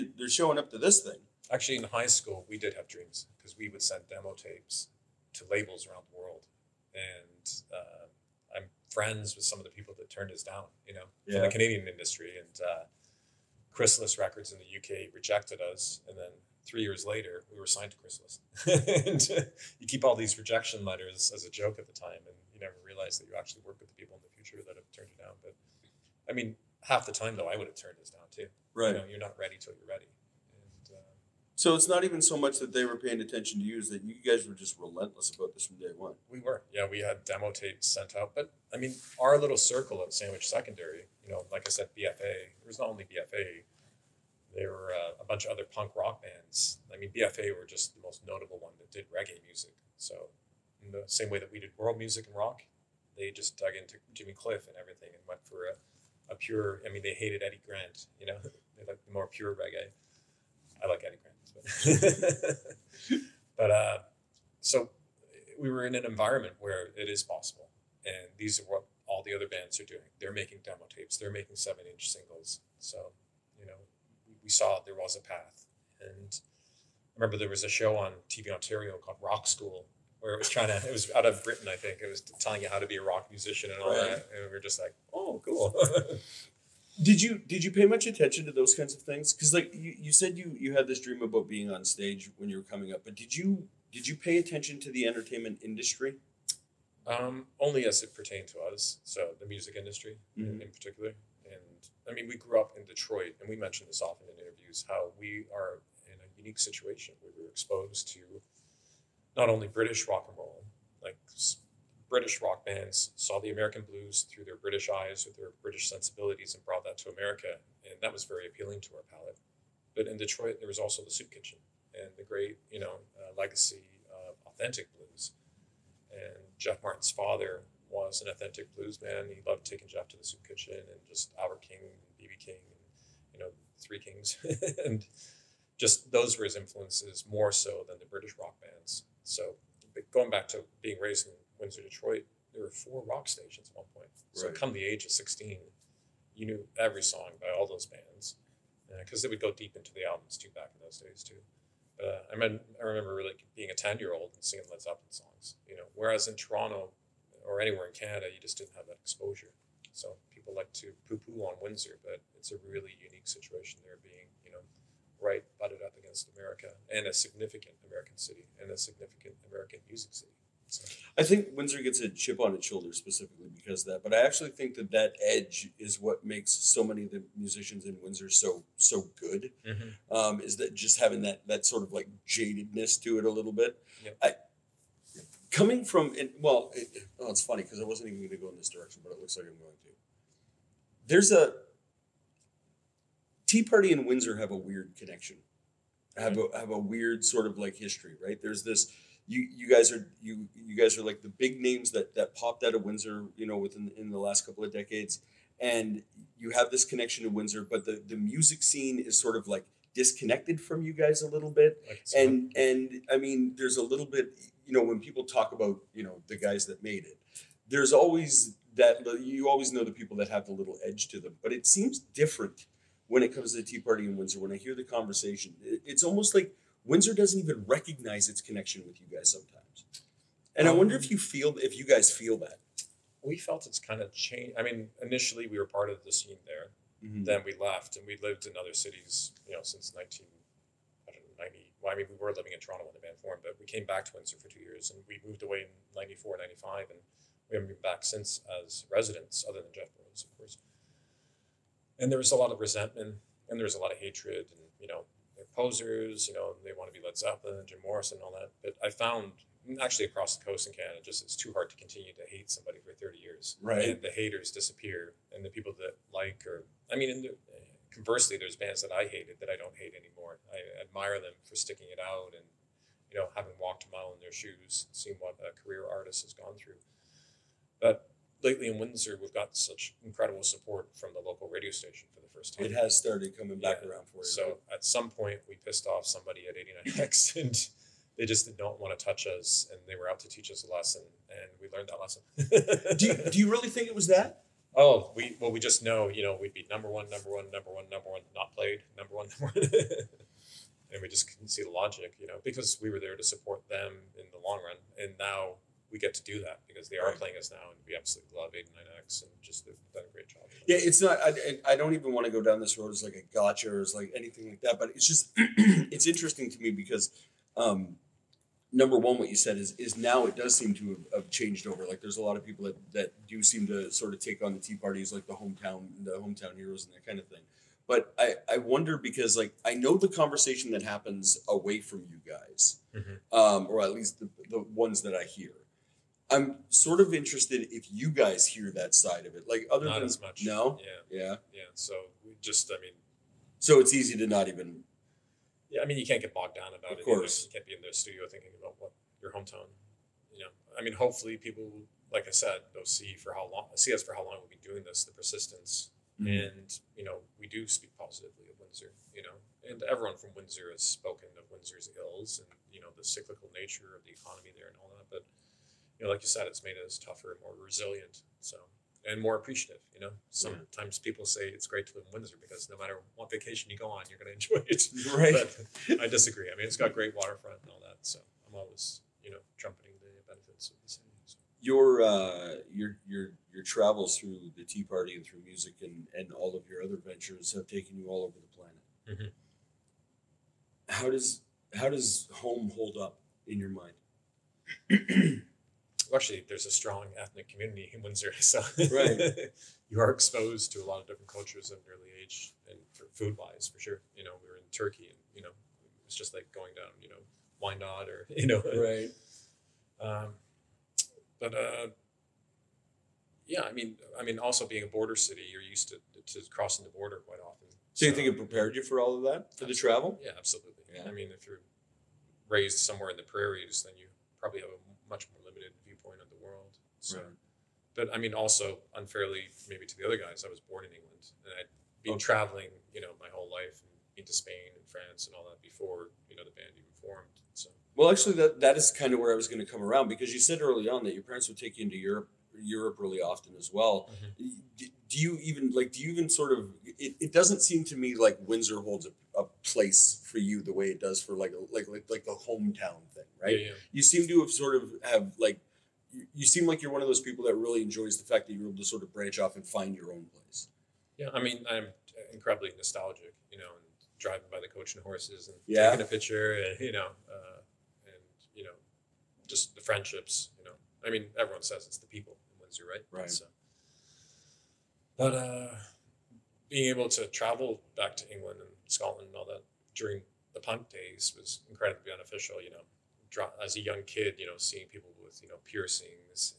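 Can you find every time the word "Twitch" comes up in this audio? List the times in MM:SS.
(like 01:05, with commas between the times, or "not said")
not said.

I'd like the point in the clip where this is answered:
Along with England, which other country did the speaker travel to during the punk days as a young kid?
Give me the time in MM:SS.
07:58.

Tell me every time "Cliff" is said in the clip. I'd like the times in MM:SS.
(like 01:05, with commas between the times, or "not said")
00:54.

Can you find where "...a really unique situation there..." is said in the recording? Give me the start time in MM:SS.
02:42.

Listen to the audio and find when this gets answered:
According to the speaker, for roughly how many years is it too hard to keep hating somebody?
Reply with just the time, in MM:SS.
04:22.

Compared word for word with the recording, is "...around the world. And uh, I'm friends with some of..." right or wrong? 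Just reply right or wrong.
right.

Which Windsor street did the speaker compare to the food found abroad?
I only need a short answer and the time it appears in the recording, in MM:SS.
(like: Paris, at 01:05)
Wyandotte, at 06:47.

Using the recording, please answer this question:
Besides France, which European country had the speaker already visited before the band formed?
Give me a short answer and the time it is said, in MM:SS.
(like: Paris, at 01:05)
Spain, at 07:14.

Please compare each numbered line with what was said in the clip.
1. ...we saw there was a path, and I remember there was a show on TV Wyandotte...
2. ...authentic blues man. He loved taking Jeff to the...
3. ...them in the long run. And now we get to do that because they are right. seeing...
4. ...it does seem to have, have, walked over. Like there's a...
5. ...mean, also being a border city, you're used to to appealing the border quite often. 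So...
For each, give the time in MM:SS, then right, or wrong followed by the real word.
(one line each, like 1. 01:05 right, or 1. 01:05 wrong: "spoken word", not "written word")
1. 01:14 wrong: "Ontario", not "Wyandotte"
2. 02:08 right
3. 05:03 wrong: "playing", not "seeing"
4. 05:20 wrong: "changed", not "walked"
5. 06:54 wrong: "crossing", not "appealing".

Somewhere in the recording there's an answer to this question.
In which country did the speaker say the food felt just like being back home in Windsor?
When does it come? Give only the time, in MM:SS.
06:44.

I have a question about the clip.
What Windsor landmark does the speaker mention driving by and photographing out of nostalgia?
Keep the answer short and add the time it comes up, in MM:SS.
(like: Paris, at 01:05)
the Coach and Horses, at 07:44.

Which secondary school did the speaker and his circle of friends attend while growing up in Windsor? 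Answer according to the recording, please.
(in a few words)
Sandwich Secondary.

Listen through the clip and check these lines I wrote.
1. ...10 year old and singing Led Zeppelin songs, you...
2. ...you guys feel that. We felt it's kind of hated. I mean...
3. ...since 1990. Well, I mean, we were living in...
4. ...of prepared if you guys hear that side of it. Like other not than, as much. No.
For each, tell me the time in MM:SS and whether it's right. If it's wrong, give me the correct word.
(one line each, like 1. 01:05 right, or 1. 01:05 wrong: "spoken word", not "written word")
1. 02:33 right
2. 03:51 wrong: "changed", not "hated"
3. 03:59 right
4. 05:36 wrong: "interested", not "prepared".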